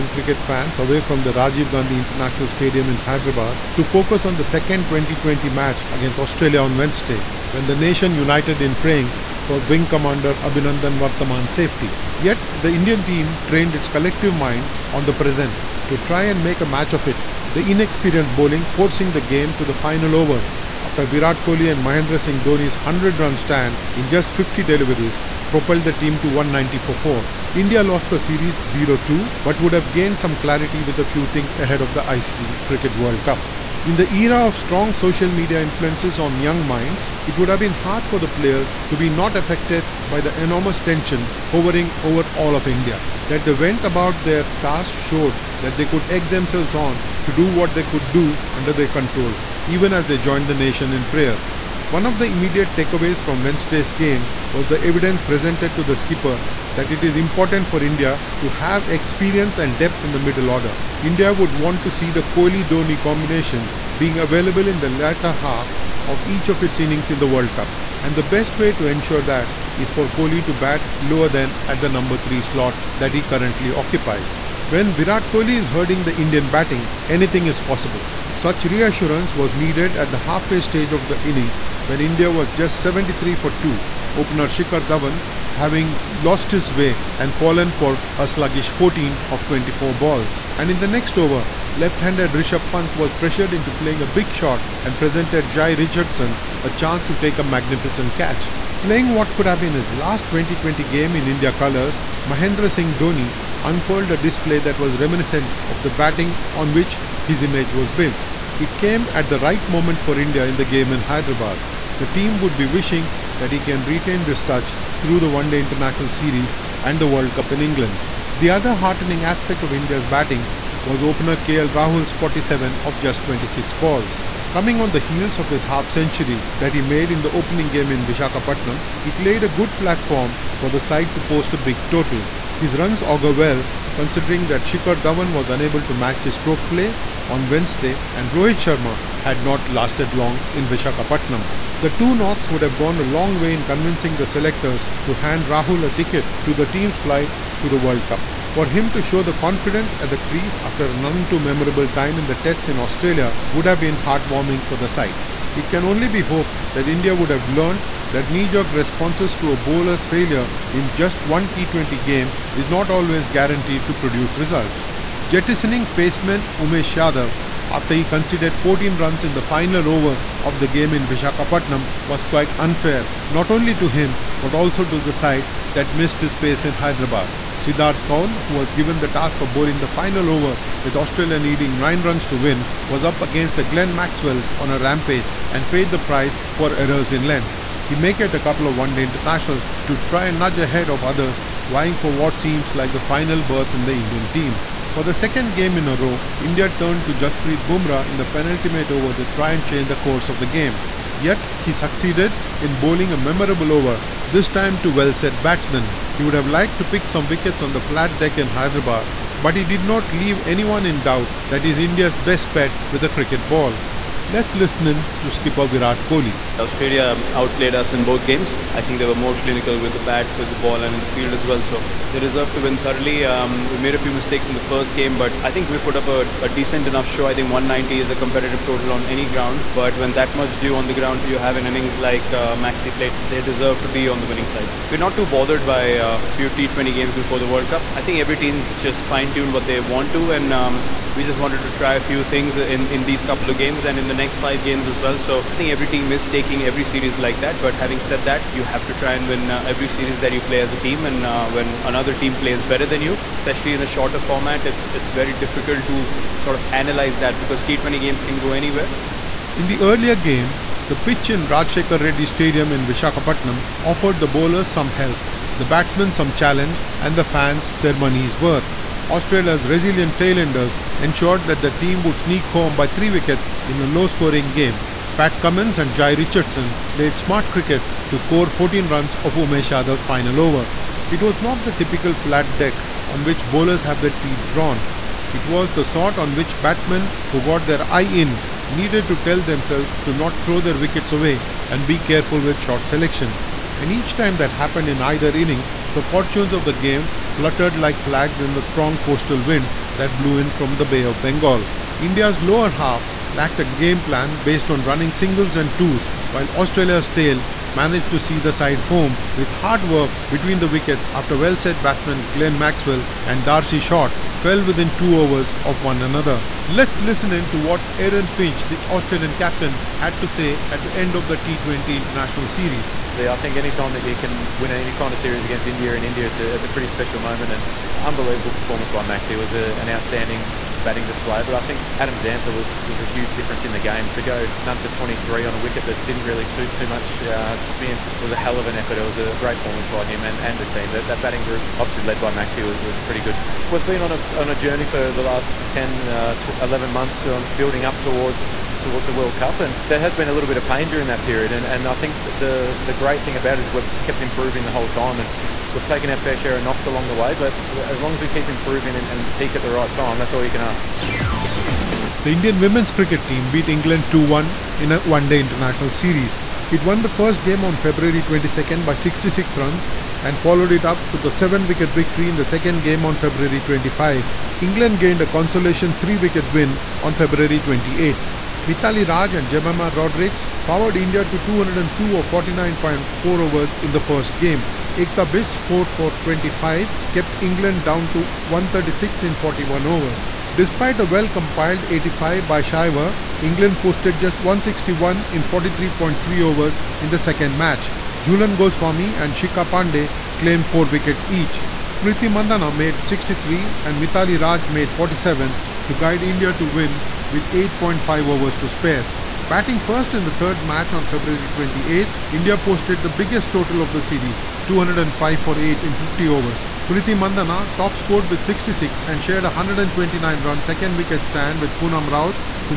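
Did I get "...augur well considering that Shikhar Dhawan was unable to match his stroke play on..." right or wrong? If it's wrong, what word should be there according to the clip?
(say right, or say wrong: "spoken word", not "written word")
right.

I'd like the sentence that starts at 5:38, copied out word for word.
It was a great performance by him and, and the team.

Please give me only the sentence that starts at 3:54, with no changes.
We're not too bothered by a uh, few T20 games before the World Cup.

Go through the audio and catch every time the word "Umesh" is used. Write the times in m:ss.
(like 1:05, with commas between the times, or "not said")
2:46, 4:39.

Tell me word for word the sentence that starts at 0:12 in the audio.
Yet, the Indian team trained its collective mind on the present to try and make a match of it.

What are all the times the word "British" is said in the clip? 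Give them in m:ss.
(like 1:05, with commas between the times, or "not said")
not said.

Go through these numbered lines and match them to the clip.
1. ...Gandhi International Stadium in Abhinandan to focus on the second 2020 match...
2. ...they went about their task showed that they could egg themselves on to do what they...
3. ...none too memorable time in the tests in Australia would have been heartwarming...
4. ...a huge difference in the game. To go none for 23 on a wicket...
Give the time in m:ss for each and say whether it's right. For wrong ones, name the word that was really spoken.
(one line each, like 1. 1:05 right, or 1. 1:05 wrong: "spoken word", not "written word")
1. 0:01 wrong: "Hyderabad", not "Abhinandan"
2. 0:43 right
3. 2:30 right
4. 5:33 right.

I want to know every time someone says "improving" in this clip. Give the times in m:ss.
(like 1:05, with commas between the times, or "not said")
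5:54, 5:58.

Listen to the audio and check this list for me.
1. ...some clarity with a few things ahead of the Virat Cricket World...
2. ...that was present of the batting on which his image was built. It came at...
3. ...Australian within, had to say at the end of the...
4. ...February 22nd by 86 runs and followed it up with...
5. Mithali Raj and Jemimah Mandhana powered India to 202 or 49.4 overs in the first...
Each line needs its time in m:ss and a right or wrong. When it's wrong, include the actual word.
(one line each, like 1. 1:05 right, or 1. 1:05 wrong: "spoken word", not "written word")
1. 0:30 wrong: "ICC", not "Virat"
2. 1:44 wrong: "reminiscent", not "present"
3. 5:18 wrong: "captain", not "within"
4. 6:07 wrong: "66", not "86"
5. 6:18 wrong: "Rodrigues", not "Mandhana".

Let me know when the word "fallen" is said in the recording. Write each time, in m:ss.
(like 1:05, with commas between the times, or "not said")
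1:27.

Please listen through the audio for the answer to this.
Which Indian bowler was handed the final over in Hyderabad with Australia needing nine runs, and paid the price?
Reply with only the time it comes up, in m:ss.
2:57.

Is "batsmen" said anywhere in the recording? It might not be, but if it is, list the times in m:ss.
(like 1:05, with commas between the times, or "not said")
3:25, 4:25, 4:46, 5:11.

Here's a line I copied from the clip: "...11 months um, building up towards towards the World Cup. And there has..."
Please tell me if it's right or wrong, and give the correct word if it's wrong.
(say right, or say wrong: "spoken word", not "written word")
right.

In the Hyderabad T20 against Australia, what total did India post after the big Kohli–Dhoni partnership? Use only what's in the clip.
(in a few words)
194/4.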